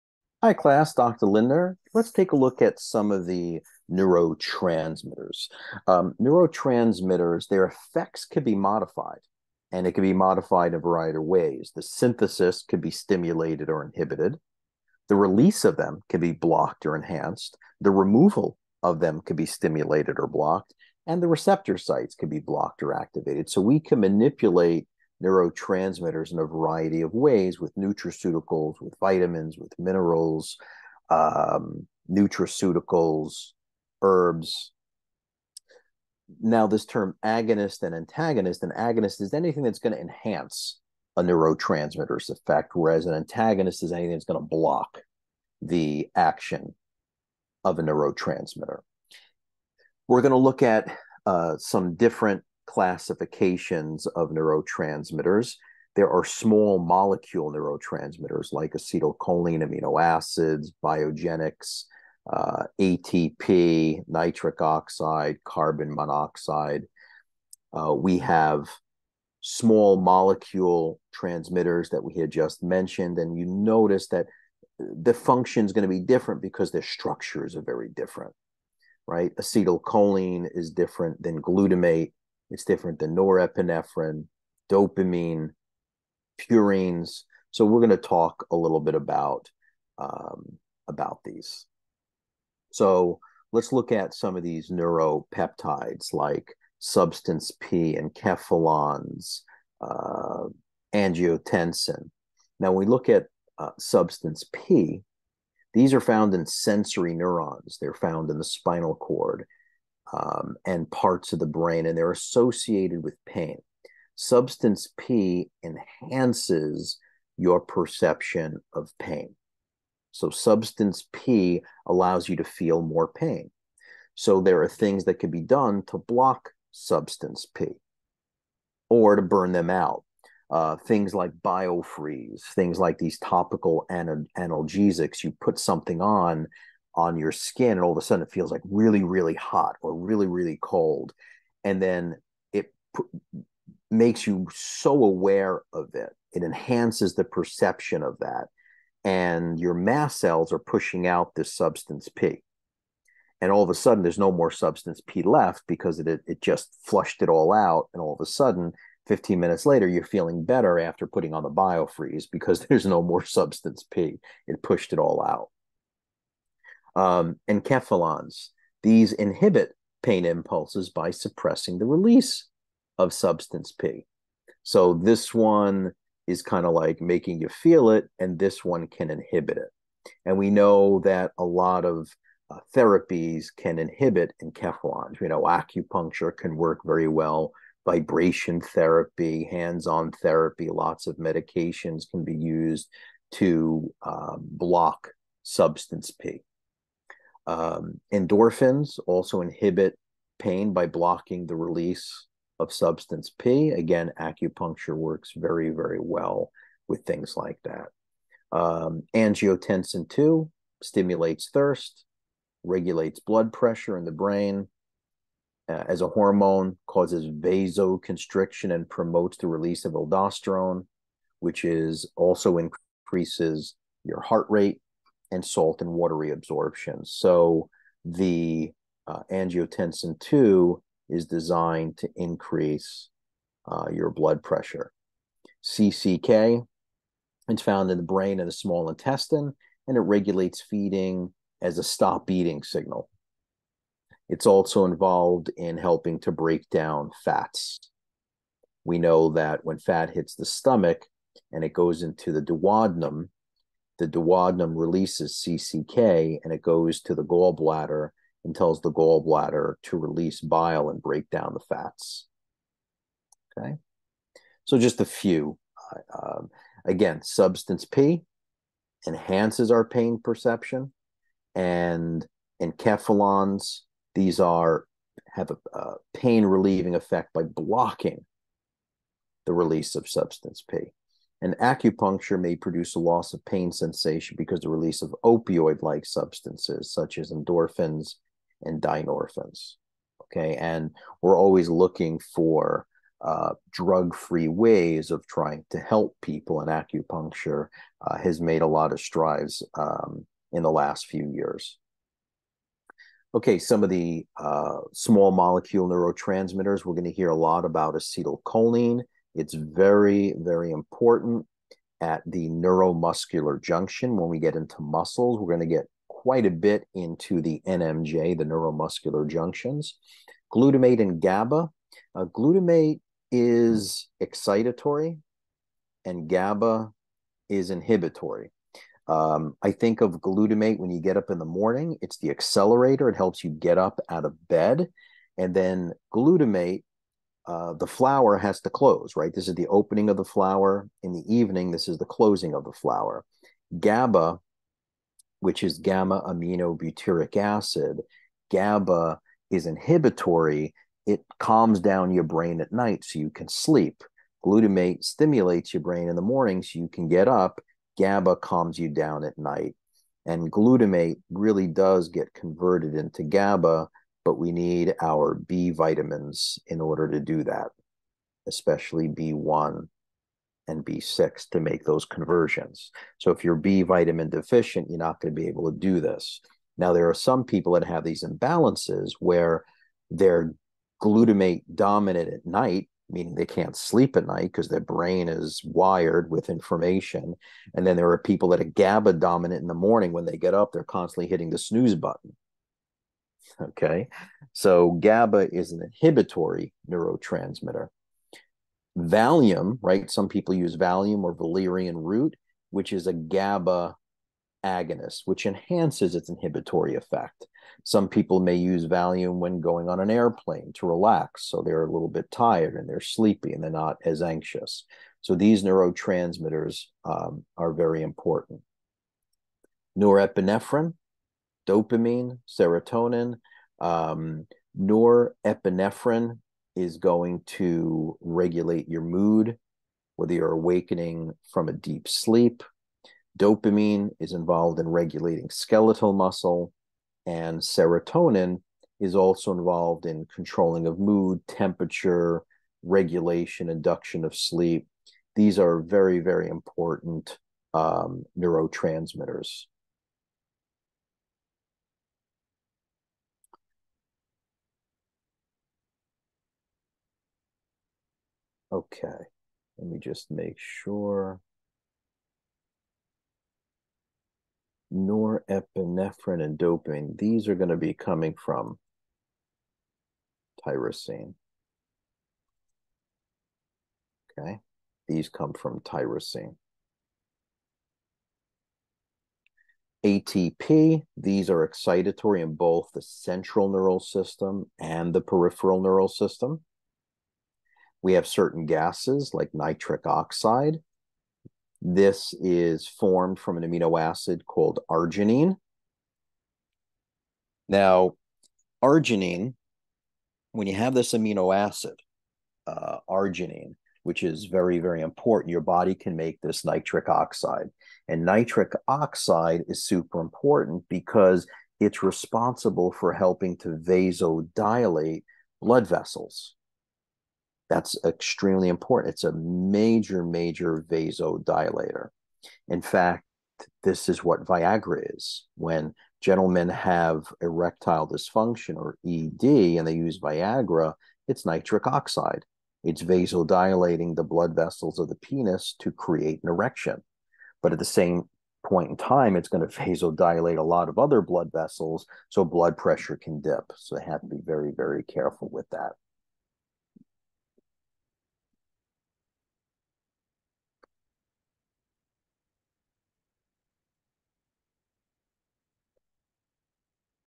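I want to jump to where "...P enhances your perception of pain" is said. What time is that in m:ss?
1:54.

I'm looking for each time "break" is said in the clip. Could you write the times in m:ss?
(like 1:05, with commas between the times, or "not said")
4:06, 4:21.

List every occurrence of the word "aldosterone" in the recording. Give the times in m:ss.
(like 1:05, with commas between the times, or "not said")
3:39.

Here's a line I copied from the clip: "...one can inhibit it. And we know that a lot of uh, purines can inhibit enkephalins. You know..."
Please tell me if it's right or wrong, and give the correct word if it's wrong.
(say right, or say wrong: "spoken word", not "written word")
wrong: "therapies", not "purines".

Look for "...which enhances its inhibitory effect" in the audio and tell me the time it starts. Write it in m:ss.
6:45.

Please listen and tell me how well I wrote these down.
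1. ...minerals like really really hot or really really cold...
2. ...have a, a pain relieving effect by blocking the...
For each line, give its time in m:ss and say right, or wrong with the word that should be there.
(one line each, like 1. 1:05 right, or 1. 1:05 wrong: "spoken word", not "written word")
1. 2:18 wrong: "feels", not "minerals"
2. 4:35 right.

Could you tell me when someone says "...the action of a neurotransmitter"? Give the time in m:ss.
0:45.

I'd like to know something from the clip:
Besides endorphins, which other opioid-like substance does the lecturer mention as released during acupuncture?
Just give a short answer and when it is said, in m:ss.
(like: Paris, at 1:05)
dynorphins, at 4:48.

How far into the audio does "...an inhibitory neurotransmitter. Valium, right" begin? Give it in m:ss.
6:35.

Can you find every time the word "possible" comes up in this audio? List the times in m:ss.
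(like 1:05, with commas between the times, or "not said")
not said.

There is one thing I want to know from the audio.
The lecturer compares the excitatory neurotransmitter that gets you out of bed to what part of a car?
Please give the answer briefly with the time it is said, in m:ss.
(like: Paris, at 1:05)
accelerator, at 5:32.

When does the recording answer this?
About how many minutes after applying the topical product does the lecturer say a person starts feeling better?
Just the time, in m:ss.
2:39.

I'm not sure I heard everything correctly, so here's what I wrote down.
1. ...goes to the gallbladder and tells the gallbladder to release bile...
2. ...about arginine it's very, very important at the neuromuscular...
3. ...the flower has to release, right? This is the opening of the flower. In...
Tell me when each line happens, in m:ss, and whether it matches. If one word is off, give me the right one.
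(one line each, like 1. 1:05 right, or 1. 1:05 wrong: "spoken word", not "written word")
1. 4:16 right
2. 5:07 wrong: "acetylcholine", not "arginine"
3. 5:37 wrong: "close", not "release".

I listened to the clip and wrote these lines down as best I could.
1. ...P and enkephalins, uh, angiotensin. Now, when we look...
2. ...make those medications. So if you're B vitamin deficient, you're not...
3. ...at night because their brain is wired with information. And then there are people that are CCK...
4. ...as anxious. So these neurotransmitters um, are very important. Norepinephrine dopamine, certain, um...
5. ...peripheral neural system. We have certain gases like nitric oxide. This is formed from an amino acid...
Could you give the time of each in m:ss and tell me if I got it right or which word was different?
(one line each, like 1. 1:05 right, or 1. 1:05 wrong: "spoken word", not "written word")
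1. 1:37 right
2. 6:11 wrong: "conversions", not "medications"
3. 6:24 wrong: "GABA", not "CCK"
4. 6:54 wrong: "serotonin", not "certain"
5. 8:05 right.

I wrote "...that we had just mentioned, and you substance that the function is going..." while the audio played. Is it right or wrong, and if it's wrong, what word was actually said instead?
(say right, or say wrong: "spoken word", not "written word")
wrong: "notice", not "substance".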